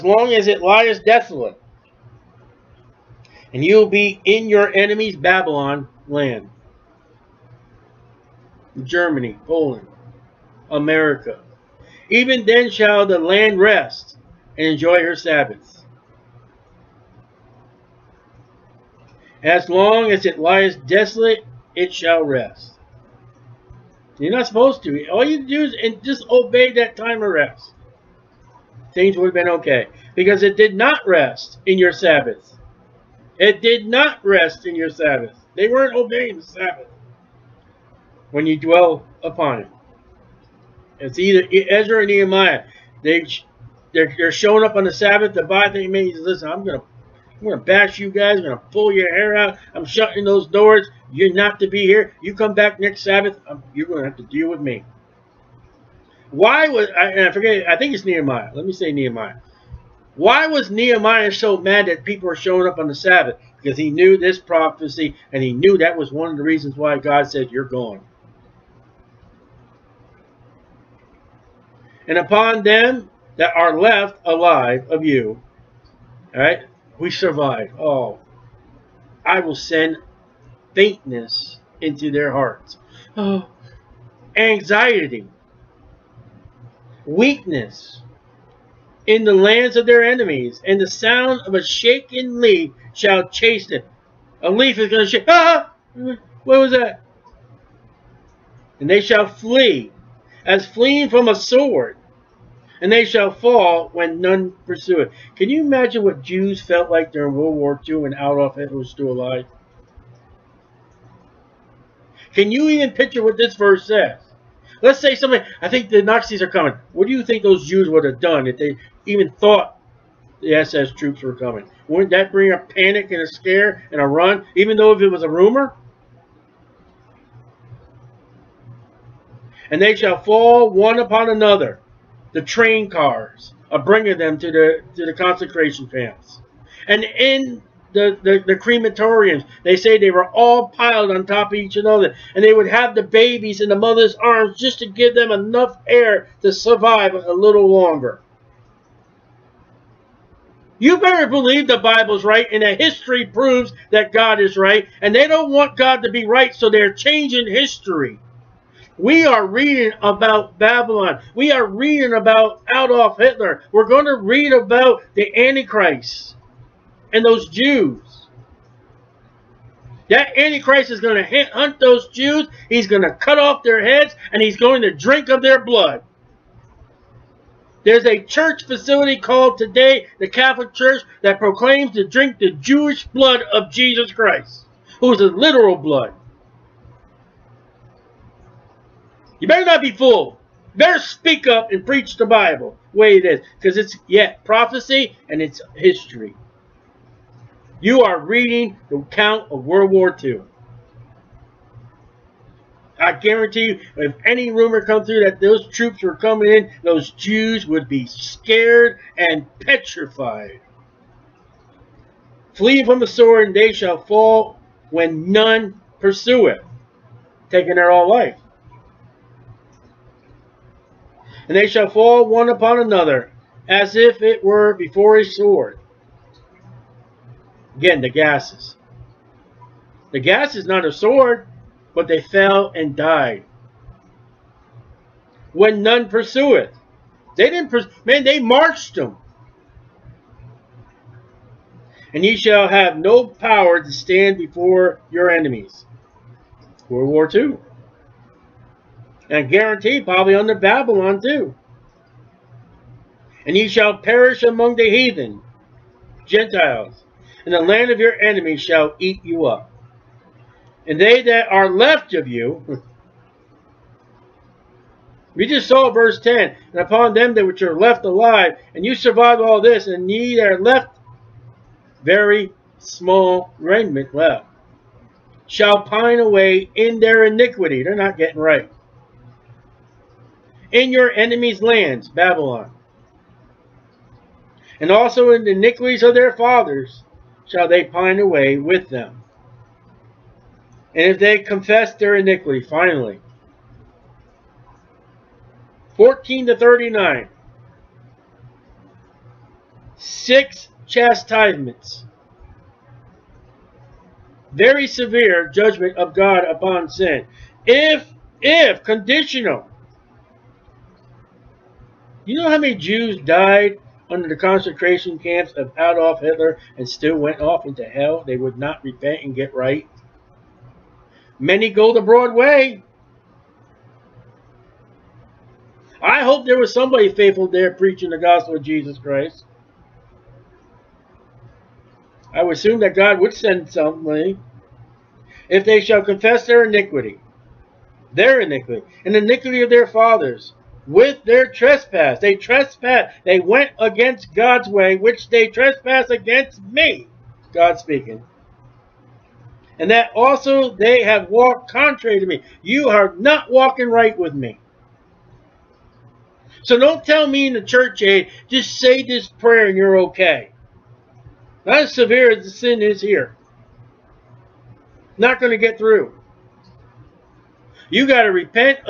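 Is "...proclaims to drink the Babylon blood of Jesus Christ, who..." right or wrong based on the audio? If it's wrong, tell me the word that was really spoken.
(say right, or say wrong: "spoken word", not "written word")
wrong: "Jewish", not "Babylon".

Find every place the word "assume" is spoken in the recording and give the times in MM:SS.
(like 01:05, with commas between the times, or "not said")
05:32.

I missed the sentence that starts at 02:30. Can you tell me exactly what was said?
You better believe the Bible's right and that history proves that God is right.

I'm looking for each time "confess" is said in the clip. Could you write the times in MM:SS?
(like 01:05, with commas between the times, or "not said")
04:51, 05:36.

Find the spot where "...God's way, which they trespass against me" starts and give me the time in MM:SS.
05:44.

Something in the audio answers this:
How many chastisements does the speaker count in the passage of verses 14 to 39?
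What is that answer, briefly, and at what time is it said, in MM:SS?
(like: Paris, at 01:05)
6, at 04:59.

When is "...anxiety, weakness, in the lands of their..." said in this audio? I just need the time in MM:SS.
01:24.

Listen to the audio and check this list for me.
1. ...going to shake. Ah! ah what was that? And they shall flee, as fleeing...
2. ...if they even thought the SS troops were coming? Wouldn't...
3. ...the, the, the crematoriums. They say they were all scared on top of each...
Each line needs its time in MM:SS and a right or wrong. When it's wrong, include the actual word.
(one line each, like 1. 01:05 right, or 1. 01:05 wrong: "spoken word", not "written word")
1. 01:34 right
2. 01:58 right
3. 02:17 wrong: "piled", not "scared".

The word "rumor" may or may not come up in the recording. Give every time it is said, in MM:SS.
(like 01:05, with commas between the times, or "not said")
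02:05, 03:24.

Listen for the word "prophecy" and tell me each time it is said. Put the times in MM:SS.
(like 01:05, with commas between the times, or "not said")
01:04, 03:14.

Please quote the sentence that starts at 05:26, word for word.
I hope there was somebody faithful there preaching the gospel of Jesus Christ.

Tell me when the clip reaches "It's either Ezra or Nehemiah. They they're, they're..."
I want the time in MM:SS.
00:40.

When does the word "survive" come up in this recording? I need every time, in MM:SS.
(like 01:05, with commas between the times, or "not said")
01:17, 02:26, 04:28.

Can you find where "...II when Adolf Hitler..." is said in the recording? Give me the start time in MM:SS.
01:47.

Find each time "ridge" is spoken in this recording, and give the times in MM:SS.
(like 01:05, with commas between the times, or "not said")
not said.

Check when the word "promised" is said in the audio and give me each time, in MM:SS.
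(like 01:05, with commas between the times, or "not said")
not said.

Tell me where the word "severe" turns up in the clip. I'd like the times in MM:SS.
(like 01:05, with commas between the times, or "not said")
05:04, 06:01.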